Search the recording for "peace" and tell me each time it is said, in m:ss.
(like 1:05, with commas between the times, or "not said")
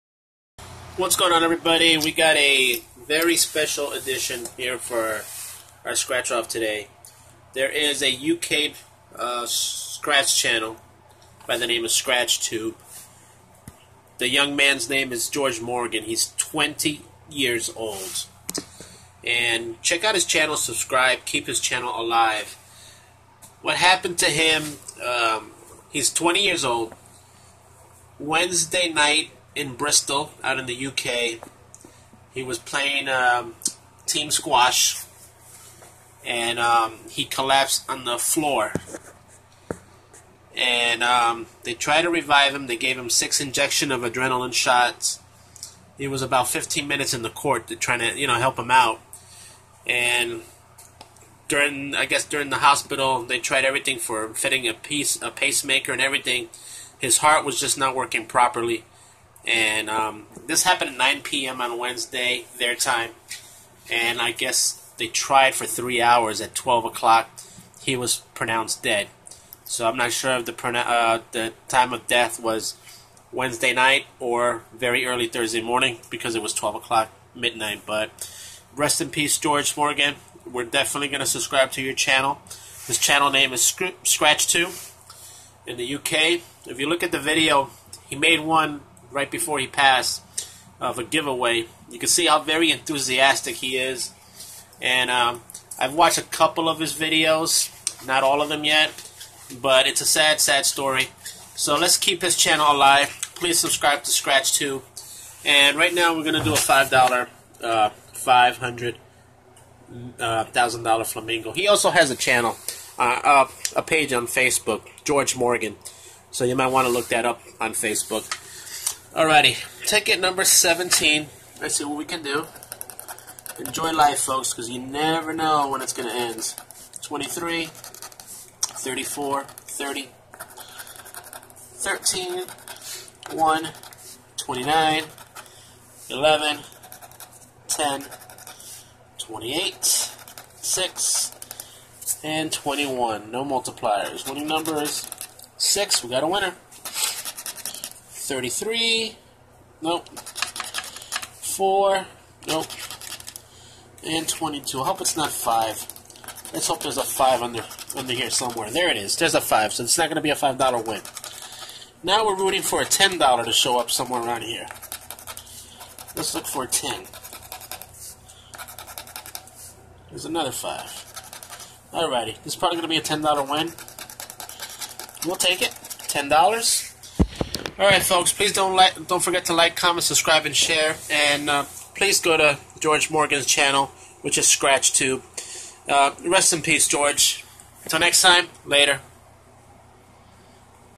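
1:19, 3:06.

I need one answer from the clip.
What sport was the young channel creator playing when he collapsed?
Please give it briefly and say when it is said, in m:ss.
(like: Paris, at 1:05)
Squash, at 0:34.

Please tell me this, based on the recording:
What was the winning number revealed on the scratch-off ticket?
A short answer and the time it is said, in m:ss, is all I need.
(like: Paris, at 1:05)
6, at 2:24.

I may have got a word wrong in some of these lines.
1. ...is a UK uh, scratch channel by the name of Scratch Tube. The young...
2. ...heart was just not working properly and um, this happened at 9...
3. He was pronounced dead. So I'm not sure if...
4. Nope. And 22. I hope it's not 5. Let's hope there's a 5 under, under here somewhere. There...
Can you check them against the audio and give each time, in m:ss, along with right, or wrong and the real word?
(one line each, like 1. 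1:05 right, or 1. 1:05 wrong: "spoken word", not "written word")
1. 0:07 right
2. 0:57 right
3. 1:07 right
4. 2:32 right.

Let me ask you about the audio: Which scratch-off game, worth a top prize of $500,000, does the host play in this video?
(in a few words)
Flamingo.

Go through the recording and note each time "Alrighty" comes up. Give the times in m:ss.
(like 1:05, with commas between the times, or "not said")
1:59, 2:51.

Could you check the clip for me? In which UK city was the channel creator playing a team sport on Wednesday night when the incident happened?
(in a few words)
Bristol.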